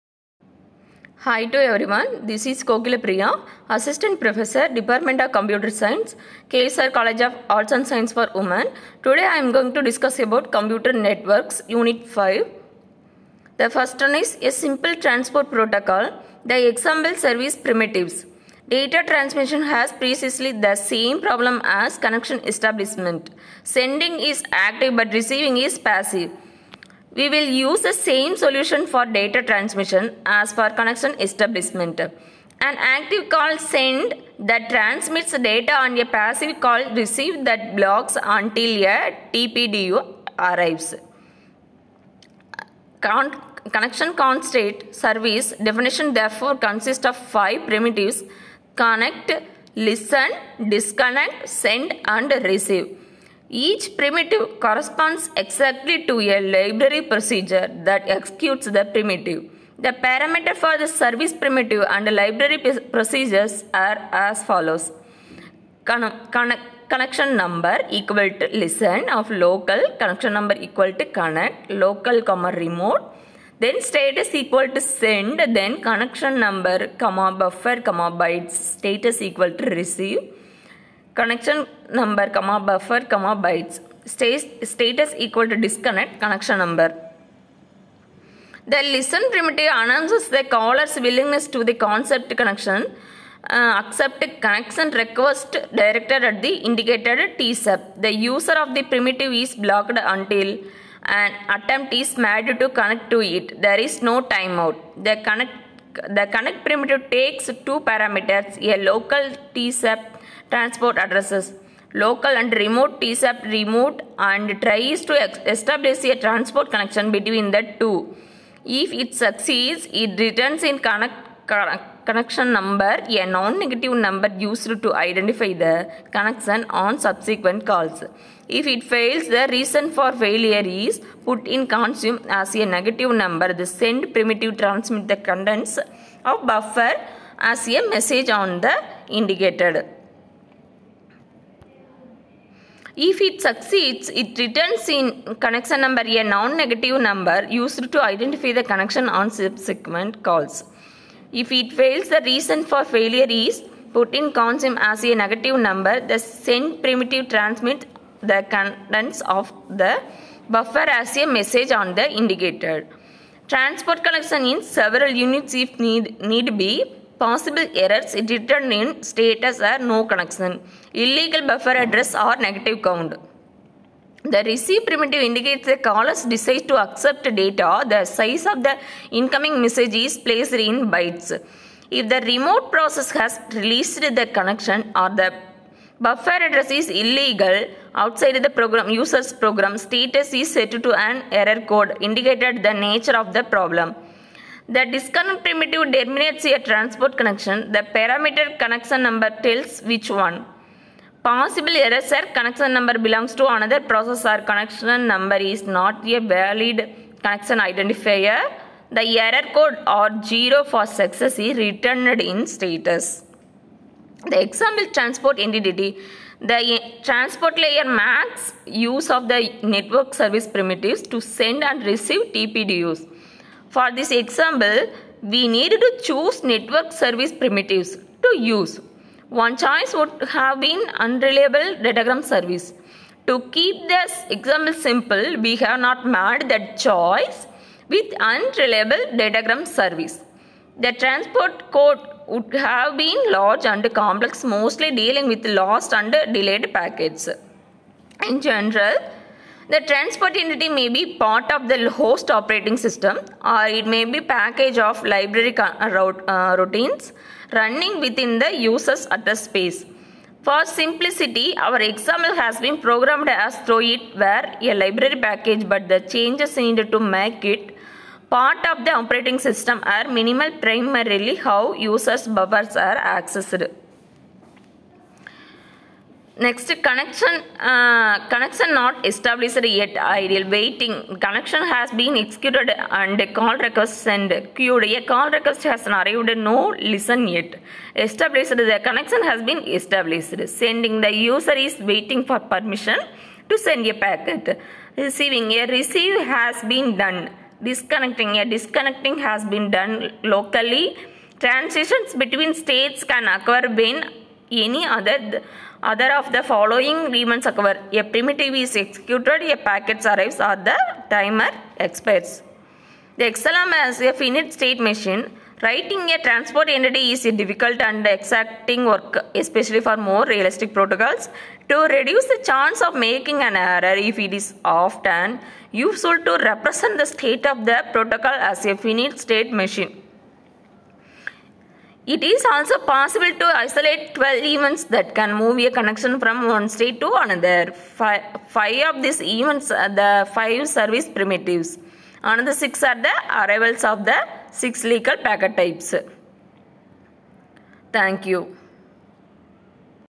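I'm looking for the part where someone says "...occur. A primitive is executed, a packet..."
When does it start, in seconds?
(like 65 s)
307 s.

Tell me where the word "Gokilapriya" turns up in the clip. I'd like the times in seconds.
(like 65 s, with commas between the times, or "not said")
2 s.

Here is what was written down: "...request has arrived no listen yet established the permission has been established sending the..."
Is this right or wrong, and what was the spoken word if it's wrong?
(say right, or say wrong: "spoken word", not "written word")
wrong: "connection", not "permission".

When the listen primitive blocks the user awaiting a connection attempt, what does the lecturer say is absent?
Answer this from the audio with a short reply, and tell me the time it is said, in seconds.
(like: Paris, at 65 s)
timeout, at 103 s.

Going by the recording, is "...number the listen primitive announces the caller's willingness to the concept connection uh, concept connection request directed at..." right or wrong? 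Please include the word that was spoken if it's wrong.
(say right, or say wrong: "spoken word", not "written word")
wrong: "accept", not "concept".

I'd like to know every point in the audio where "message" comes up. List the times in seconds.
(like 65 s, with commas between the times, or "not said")
137 s, 161 s, 179 s.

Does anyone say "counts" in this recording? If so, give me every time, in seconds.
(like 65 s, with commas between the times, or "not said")
154 s, 172 s.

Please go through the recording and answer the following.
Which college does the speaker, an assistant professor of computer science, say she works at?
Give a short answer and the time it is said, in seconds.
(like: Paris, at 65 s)
KSR College of Arts and Science for Women, at 6 s.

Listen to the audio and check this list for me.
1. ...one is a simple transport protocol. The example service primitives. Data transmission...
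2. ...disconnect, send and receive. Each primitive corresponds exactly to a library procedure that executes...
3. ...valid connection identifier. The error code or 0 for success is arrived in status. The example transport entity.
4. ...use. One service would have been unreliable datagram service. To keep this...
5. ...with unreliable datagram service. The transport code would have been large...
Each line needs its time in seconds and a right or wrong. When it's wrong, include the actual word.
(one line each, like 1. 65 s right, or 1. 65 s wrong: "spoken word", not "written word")
1. 14 s right
2. 50 s right
3. 206 s wrong: "returned", not "arrived"
4. 228 s wrong: "choice", not "service"
5. 237 s right.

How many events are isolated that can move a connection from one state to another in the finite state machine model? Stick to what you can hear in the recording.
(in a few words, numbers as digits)
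12.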